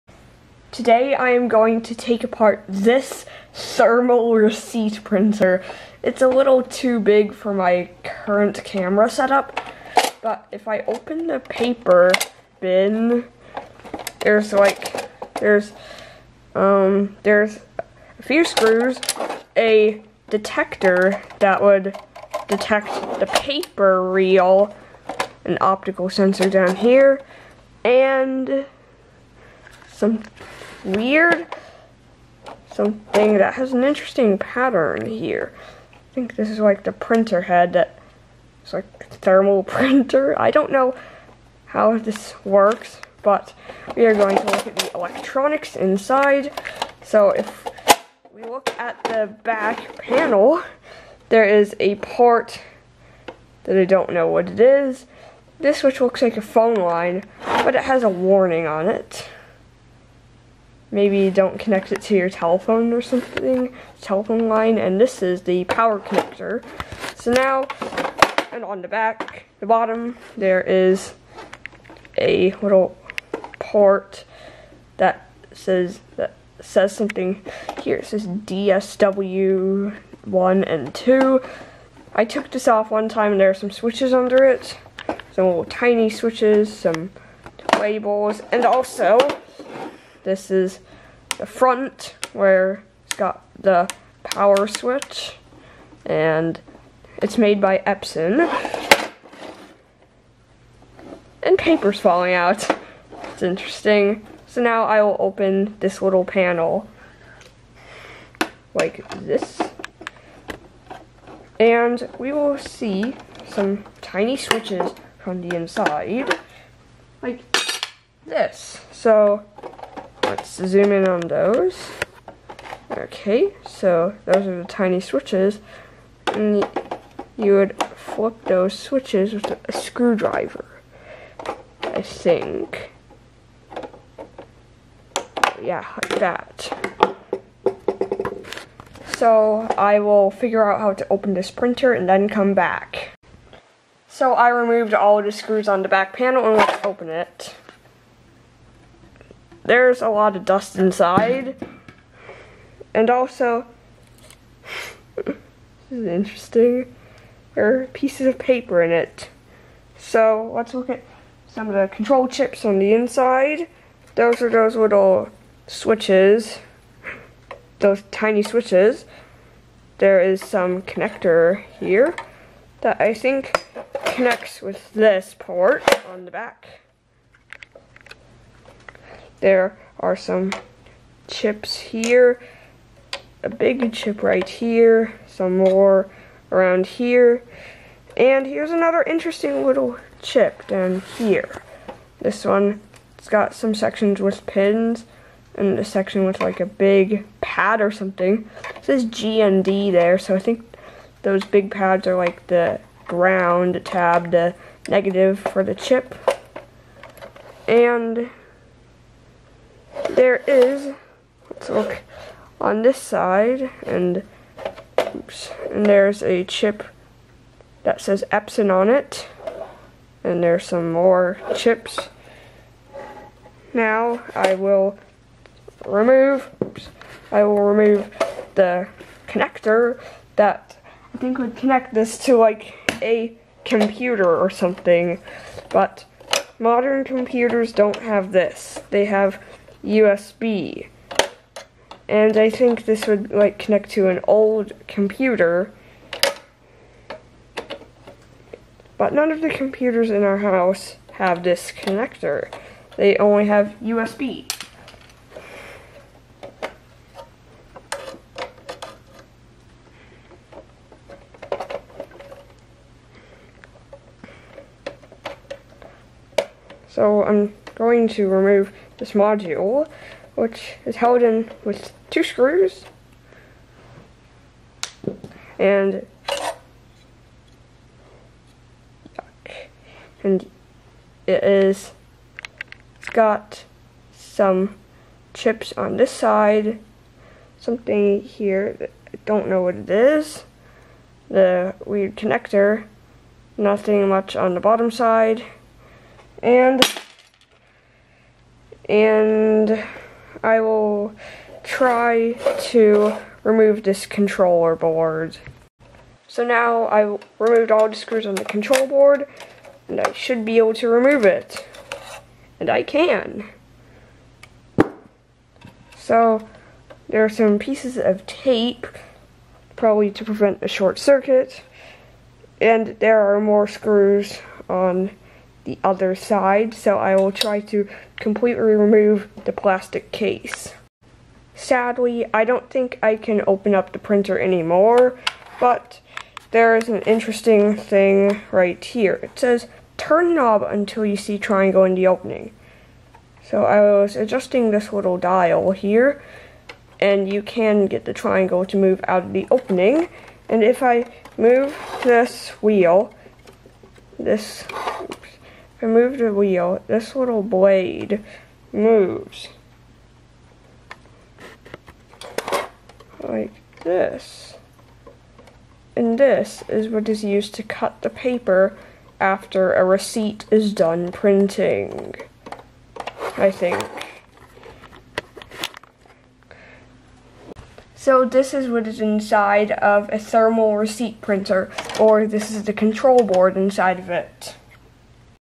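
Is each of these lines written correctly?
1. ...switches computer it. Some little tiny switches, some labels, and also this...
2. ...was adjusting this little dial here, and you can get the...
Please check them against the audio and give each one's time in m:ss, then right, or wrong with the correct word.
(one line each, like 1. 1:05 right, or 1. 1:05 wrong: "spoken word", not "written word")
1. 1:23 wrong: "under", not "computer"
2. 5:43 right.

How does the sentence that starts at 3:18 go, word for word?
It says GND there, so I think those big pads are like the ground tab, the negative for the chip.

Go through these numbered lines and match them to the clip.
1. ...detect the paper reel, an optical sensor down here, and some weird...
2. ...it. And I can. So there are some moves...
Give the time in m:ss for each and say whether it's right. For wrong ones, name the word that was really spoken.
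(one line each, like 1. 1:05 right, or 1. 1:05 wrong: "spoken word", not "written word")
1. 0:22 right
2. 5:11 wrong: "pieces", not "moves".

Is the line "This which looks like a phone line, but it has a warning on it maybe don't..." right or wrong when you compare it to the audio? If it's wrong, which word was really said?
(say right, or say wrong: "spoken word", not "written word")
right.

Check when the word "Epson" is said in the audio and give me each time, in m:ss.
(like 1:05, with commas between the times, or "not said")
1:37, 3:38.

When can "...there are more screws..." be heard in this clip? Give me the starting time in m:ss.
5:22.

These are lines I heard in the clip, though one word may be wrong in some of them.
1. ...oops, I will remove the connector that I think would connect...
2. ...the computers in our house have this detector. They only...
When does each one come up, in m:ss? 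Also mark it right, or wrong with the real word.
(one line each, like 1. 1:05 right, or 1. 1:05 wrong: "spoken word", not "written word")
1. 3:46 right
2. 4:09 wrong: "connector", not "detector".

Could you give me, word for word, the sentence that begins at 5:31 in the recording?
Sadly, I don't think I can open up the printer anymore, but there is an interesting thing right here.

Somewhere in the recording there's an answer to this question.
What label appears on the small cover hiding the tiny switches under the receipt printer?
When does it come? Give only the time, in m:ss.
1:18.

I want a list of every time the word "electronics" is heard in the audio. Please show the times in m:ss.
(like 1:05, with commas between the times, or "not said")
0:44.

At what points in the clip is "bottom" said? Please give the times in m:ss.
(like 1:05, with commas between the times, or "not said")
1:09, 4:54.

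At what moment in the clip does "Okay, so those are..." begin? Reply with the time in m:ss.
2:02.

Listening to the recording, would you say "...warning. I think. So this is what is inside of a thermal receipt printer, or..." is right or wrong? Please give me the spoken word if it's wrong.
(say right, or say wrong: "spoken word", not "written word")
wrong: "printing", not "warning".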